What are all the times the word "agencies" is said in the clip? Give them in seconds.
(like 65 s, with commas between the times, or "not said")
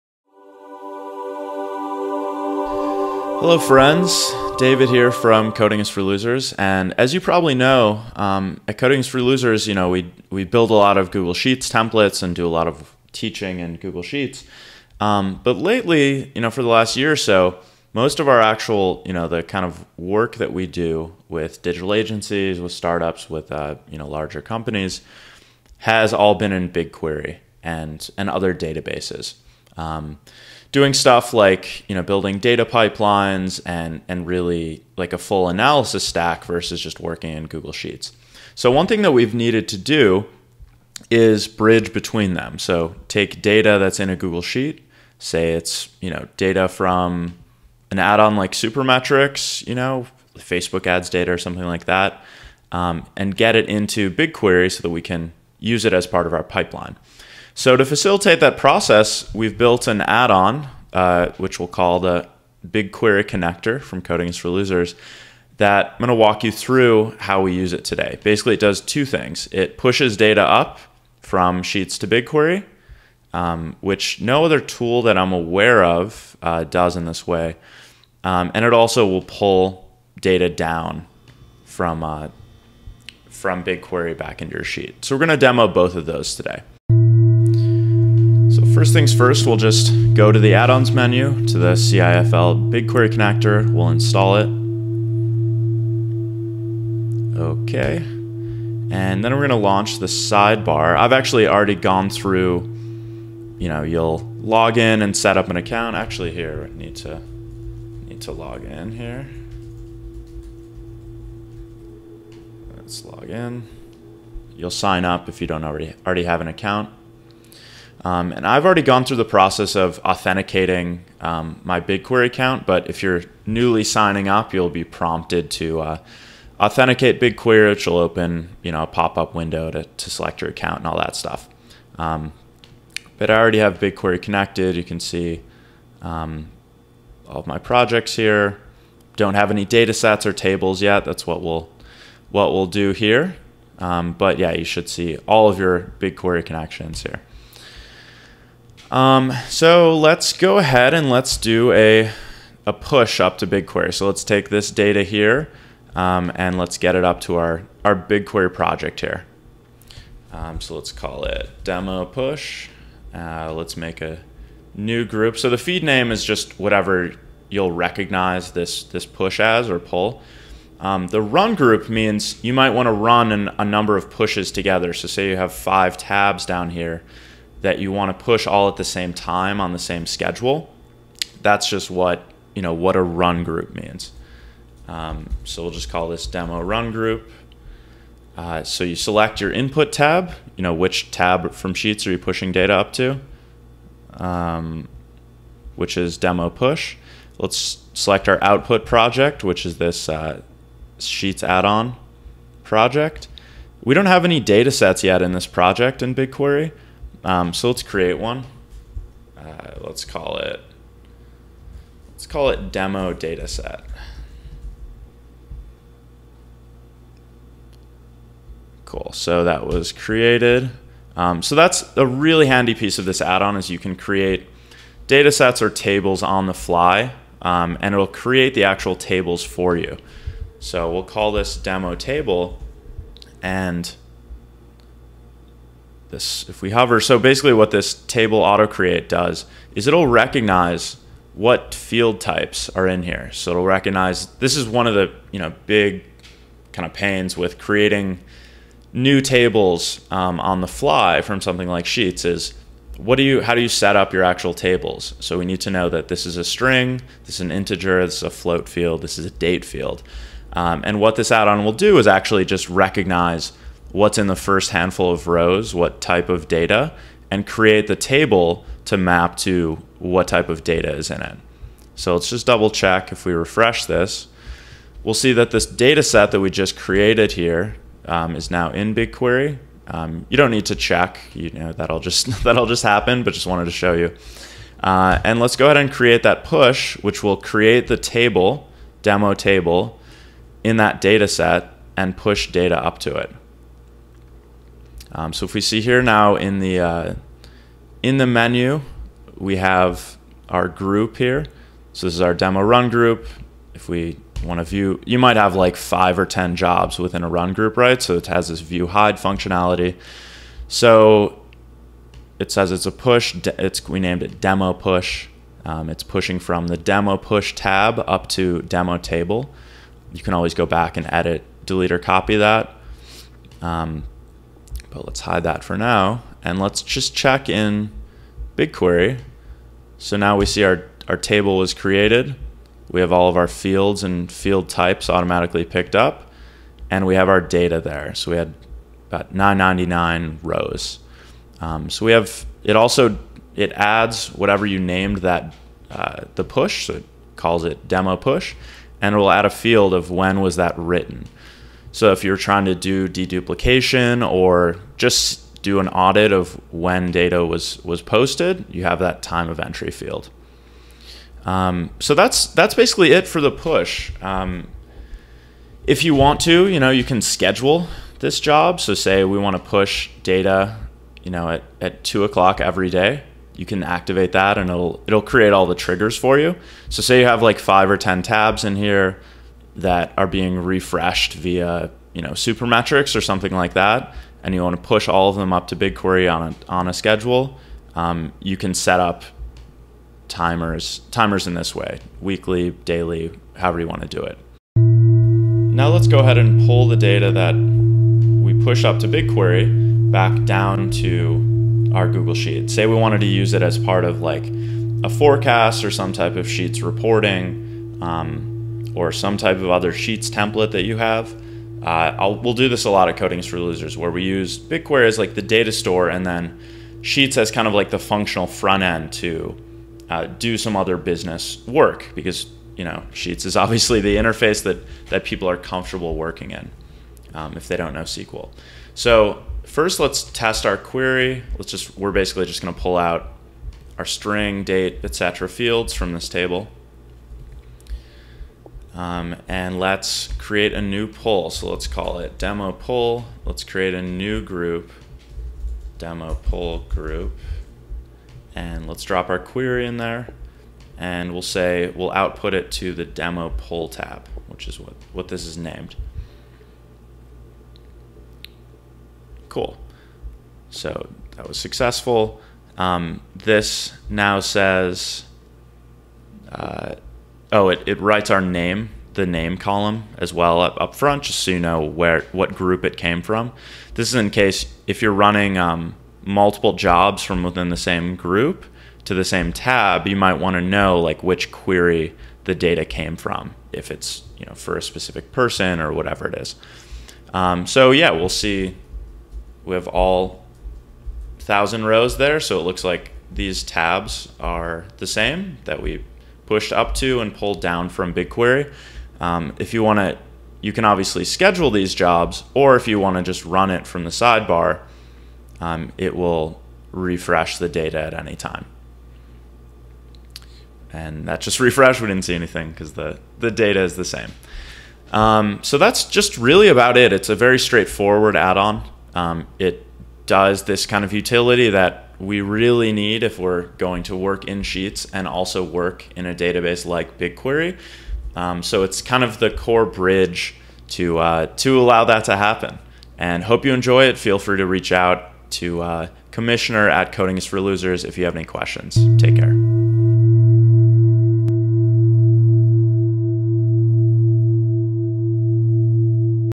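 21 s.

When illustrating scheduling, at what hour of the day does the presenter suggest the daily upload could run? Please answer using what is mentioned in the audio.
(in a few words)
2 o'clock.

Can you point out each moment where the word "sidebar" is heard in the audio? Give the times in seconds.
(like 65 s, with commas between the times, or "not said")
100 s, 504 s.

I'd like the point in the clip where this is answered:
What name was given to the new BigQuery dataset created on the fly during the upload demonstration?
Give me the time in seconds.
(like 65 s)
212 s.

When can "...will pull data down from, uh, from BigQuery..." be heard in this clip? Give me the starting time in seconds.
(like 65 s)
79 s.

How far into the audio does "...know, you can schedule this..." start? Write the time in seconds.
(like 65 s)
366 s.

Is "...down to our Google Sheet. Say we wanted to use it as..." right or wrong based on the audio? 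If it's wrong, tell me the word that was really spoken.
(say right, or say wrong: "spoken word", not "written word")
right.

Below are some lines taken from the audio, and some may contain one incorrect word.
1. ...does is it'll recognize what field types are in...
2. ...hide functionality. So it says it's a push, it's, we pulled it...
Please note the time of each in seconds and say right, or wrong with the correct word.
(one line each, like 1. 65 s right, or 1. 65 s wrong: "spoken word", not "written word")
1. 239 s right
2. 308 s wrong: "named", not "pulled".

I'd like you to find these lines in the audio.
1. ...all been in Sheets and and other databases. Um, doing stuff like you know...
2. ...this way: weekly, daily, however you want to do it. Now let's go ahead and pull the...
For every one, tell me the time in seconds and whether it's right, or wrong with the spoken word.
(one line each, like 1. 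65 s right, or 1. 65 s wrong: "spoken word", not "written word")
1. 26 s wrong: "BigQuery", not "Sheets"
2. 391 s right.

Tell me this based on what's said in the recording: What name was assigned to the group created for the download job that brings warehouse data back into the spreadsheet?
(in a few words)
demo poll group.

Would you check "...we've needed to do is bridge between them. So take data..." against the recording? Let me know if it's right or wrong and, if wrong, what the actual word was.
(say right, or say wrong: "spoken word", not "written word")
right.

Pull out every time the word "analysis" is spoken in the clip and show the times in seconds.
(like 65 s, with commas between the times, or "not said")
35 s.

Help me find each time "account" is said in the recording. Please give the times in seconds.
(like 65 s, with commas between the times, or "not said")
105 s, 116 s, 122 s, 130 s.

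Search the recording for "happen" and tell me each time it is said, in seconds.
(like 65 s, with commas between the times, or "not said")
282 s, 532 s.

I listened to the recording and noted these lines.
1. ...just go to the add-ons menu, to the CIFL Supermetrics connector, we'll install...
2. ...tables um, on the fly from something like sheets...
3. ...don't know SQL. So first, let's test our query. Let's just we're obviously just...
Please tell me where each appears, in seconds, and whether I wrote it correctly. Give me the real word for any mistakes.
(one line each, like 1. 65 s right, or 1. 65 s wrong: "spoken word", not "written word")
1. 89 s wrong: "BigQuery", not "Supermetrics"
2. 249 s right
3. 427 s wrong: "basically", not "obviously".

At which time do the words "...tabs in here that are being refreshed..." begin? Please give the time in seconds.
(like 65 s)
378 s.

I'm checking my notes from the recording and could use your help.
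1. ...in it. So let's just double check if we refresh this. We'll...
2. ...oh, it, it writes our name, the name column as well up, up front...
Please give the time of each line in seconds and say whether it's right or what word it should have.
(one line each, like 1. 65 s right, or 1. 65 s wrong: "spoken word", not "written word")
1. 271 s right
2. 467 s right.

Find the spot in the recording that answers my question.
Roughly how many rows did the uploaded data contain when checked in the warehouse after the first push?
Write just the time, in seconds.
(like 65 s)
339 s.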